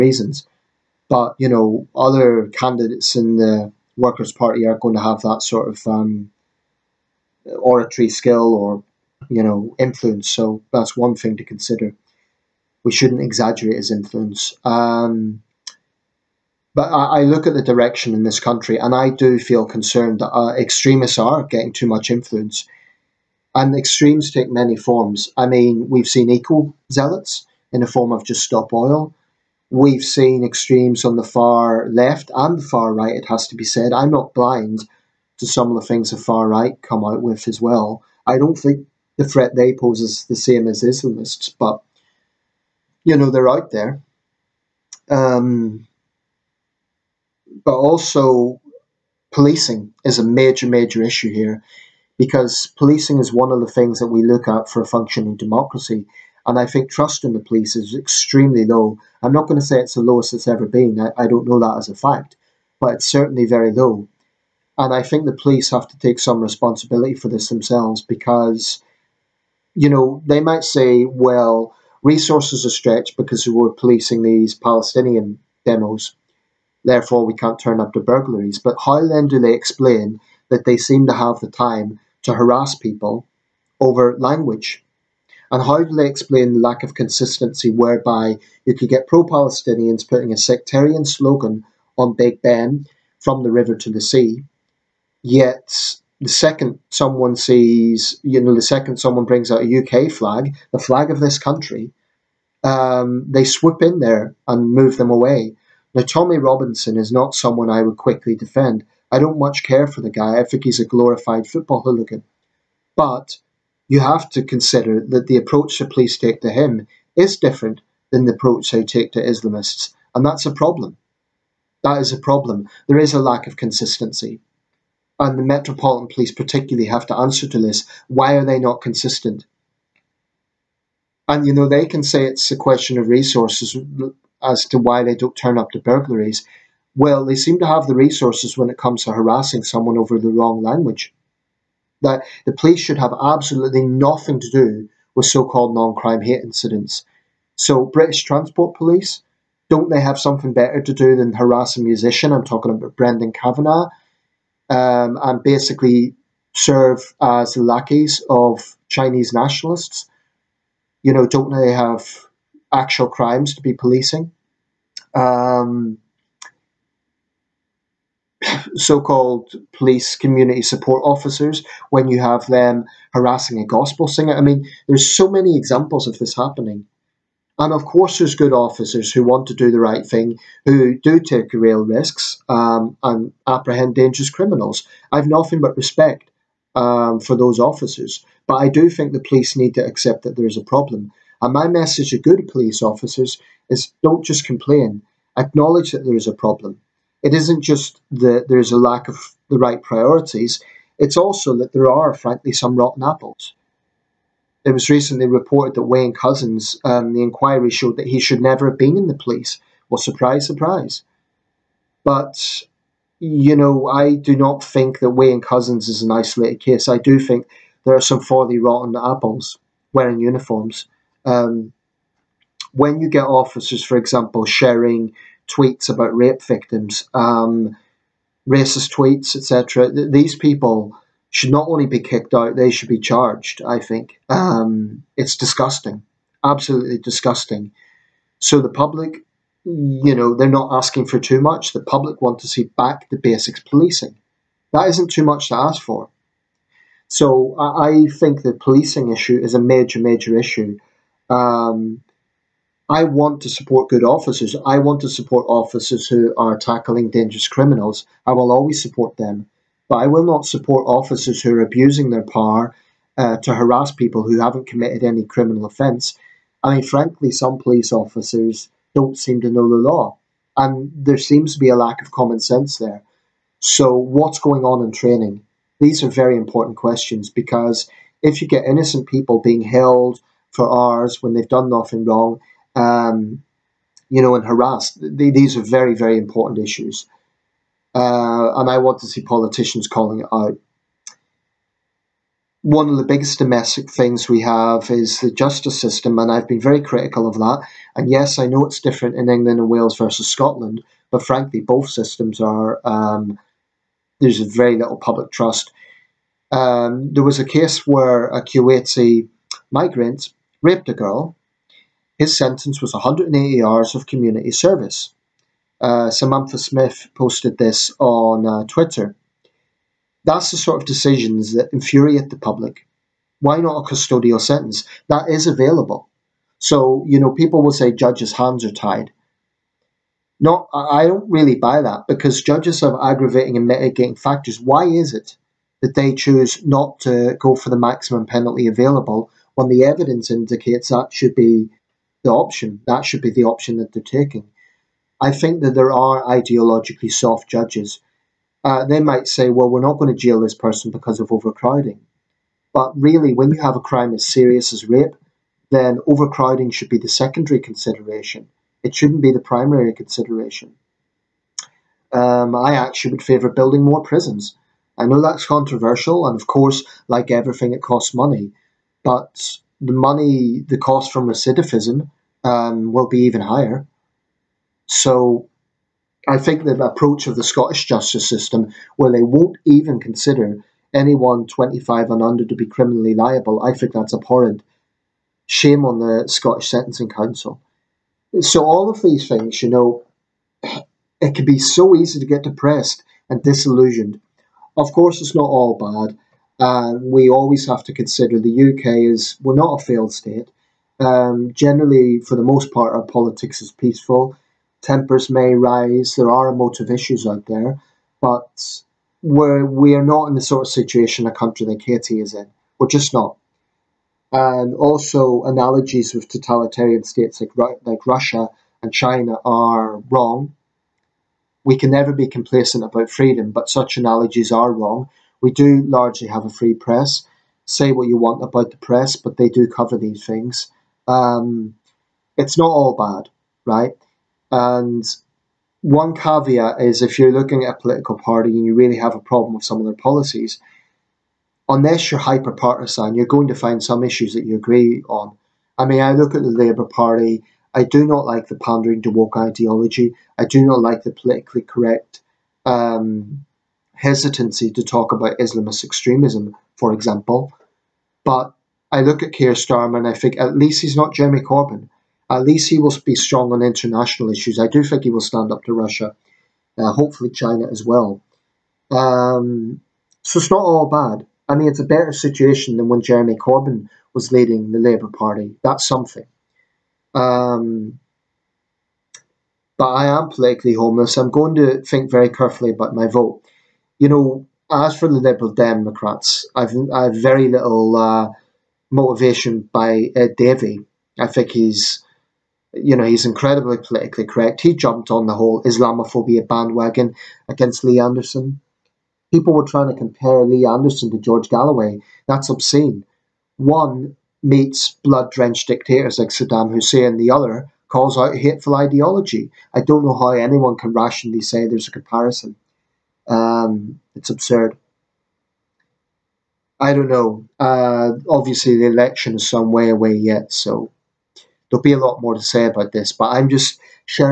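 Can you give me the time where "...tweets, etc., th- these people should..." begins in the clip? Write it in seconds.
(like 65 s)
228 s.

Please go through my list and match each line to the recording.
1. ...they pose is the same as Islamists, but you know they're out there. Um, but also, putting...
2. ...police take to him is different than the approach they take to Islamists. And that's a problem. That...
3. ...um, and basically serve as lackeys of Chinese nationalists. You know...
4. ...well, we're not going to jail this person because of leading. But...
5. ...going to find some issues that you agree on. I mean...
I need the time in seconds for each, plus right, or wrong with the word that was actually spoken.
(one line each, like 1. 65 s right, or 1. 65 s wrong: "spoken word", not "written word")
1. 39 s wrong: "policing", not "putting"
2. 115 s right
3. 154 s right
4. 349 s wrong: "overcrowding", not "leading"
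5. 443 s right.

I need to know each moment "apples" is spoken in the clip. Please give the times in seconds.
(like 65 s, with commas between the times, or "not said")
203 s, 218 s.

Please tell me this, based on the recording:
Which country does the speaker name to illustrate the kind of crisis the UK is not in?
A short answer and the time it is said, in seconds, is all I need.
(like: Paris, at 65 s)
Haiti, at 411 s.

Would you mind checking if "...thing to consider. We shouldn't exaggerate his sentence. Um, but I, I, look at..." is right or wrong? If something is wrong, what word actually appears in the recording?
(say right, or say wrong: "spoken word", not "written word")
wrong: "influence", not "sentence".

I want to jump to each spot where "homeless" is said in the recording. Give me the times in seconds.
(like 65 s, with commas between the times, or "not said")
480 s.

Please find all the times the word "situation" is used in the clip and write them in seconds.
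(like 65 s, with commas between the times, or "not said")
410 s, 472 s.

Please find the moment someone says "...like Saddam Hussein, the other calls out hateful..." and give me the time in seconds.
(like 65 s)
506 s.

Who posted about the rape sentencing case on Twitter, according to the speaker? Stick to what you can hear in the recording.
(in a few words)
Samantha Smith.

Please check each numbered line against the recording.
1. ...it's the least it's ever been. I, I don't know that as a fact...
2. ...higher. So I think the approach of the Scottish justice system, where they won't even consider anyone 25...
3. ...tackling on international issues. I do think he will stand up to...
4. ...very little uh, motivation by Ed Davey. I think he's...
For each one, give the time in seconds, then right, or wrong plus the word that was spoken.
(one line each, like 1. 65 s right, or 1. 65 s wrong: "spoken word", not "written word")
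1. 59 s wrong: "lowest", not "least"
2. 373 s right
3. 463 s wrong: "strong", not "tackling"
4. 487 s right.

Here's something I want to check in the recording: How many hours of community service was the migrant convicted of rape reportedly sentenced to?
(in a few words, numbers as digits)
180.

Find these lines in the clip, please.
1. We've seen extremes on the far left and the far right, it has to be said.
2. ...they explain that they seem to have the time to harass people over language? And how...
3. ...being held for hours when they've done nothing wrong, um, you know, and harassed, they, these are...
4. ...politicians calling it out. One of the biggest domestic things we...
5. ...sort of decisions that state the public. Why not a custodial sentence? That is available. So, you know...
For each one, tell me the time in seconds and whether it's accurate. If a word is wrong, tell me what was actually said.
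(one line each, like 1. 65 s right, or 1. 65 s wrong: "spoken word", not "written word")
1. 29 s right
2. 79 s right
3. 279 s right
4. 289 s right
5. 320 s wrong: "infuriate", not "state".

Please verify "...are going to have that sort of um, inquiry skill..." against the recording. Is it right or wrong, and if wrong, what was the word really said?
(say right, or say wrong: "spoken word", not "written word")
wrong: "oratory", not "inquiry".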